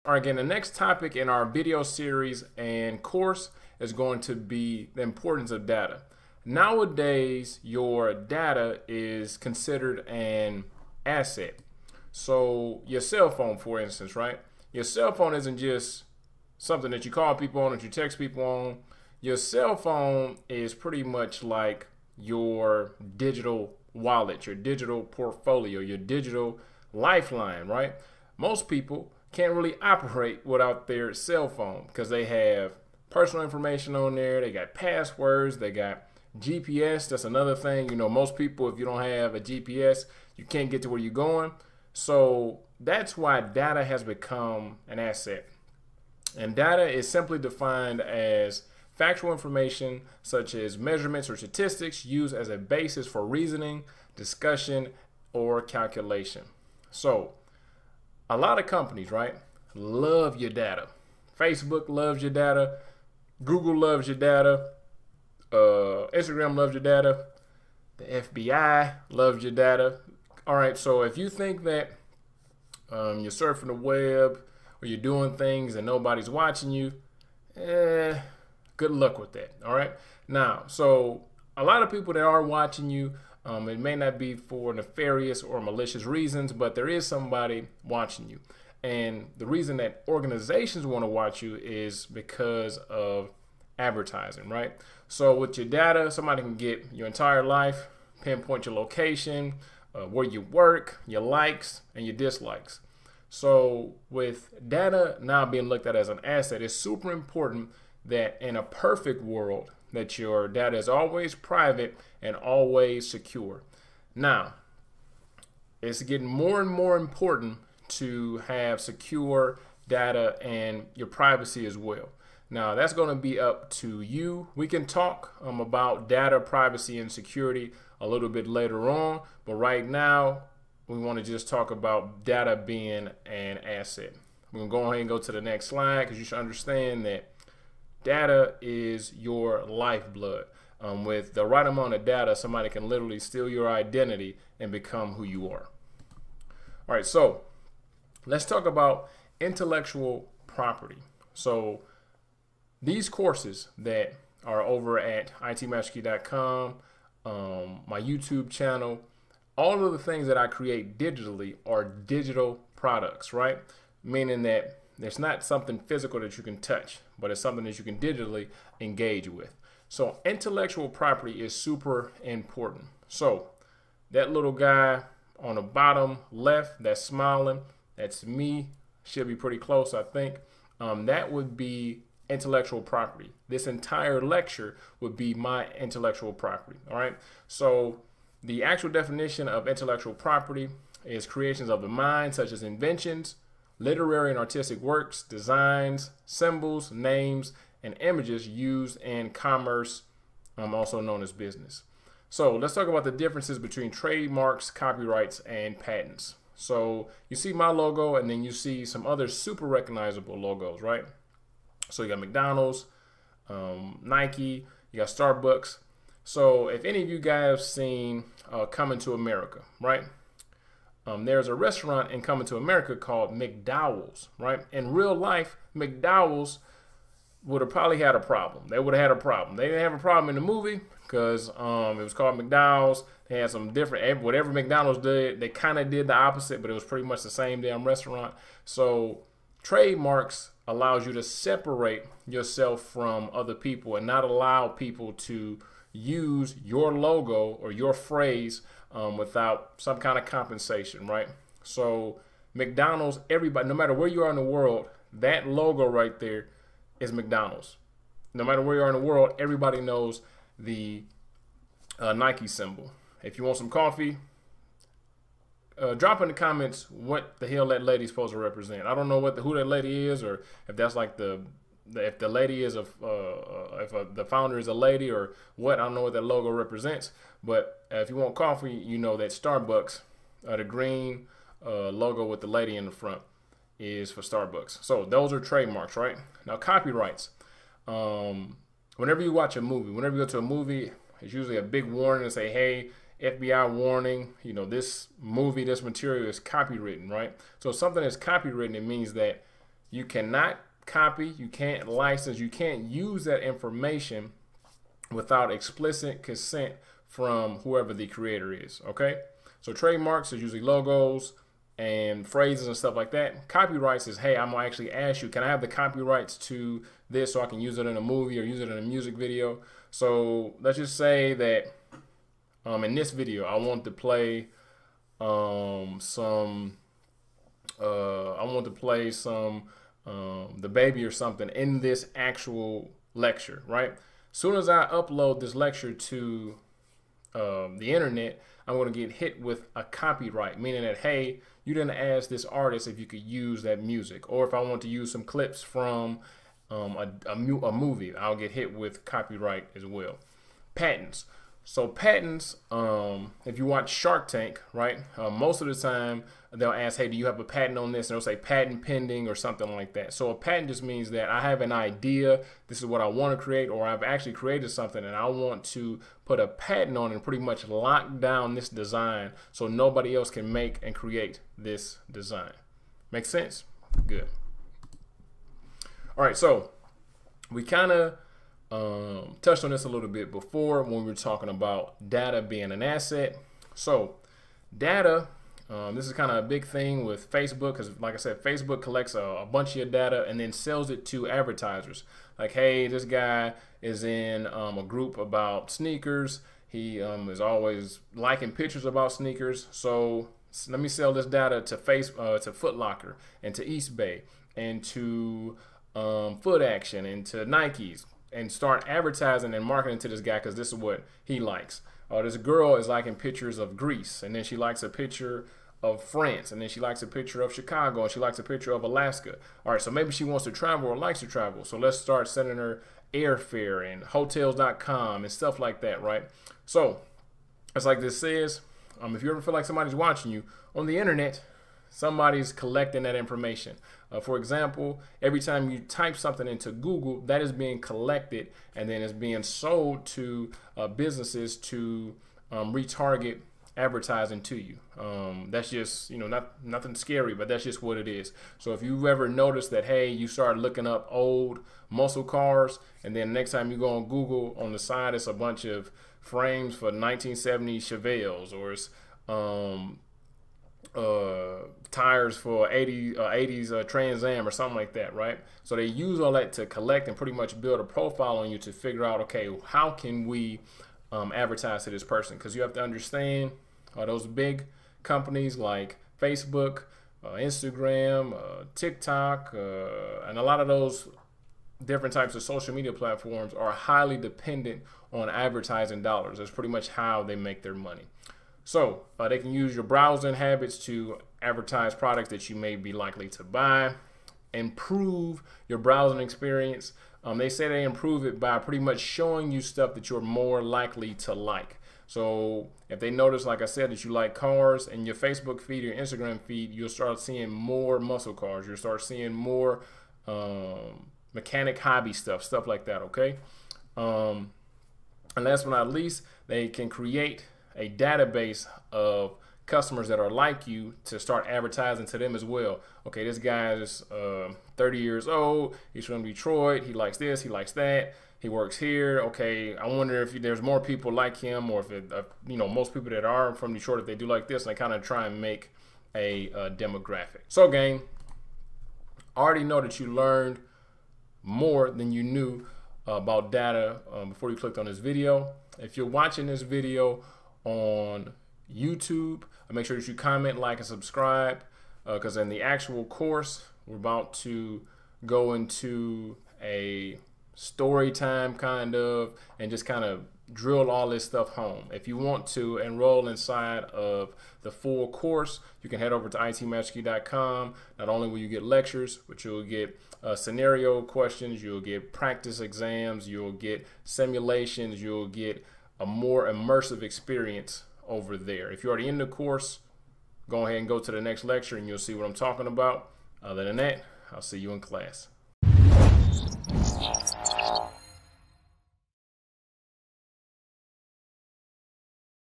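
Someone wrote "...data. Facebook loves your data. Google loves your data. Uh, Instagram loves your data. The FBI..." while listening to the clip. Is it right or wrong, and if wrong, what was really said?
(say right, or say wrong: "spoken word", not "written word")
right.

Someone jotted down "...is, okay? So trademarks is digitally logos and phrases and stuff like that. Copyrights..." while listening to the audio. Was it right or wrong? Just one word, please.
wrong.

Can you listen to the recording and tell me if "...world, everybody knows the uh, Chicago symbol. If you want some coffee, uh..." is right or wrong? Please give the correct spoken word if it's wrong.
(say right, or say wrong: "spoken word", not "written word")
wrong: "Nike", not "Chicago".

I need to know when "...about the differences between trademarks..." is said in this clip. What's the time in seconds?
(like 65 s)
202 s.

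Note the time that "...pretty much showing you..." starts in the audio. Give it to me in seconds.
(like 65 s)
498 s.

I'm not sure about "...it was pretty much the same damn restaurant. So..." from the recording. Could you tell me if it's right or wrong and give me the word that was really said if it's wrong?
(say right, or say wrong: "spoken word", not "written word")
right.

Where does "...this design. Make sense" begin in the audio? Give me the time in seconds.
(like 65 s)
371 s.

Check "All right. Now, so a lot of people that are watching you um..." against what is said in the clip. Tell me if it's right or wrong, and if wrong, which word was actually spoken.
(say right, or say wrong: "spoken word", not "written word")
right.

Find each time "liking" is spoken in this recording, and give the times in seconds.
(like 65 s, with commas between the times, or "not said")
398 s, 412 s.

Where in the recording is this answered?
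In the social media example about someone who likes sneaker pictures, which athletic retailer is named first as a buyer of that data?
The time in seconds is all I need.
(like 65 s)
402 s.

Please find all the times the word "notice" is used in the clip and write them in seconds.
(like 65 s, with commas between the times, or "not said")
449 s, 503 s.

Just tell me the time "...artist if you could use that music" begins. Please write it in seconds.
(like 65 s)
342 s.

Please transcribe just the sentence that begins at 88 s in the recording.
And the reason that organizations want to watch you is because of advertising, right?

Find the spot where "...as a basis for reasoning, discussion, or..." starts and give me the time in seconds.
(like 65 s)
52 s.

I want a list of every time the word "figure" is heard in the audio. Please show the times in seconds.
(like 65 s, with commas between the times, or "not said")
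468 s.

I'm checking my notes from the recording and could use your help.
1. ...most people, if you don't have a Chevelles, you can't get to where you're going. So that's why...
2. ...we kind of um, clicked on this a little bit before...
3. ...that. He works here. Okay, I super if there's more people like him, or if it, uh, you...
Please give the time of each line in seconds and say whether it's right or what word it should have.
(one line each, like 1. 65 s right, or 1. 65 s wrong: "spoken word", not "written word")
1. 38 s wrong: "GPS", not "Chevelles"
2. 377 s wrong: "touched", not "clicked"
3. 527 s wrong: "wonder", not "super".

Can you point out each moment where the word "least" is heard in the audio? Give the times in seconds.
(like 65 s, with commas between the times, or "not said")
515 s.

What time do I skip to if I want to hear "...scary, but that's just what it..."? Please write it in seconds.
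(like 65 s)
446 s.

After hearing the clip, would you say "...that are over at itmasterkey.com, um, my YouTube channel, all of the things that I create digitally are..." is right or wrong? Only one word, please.
right.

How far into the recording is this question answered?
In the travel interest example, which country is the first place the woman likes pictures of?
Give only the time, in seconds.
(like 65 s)
413 s.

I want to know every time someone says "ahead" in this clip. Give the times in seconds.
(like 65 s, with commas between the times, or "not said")
134 s, 580 s.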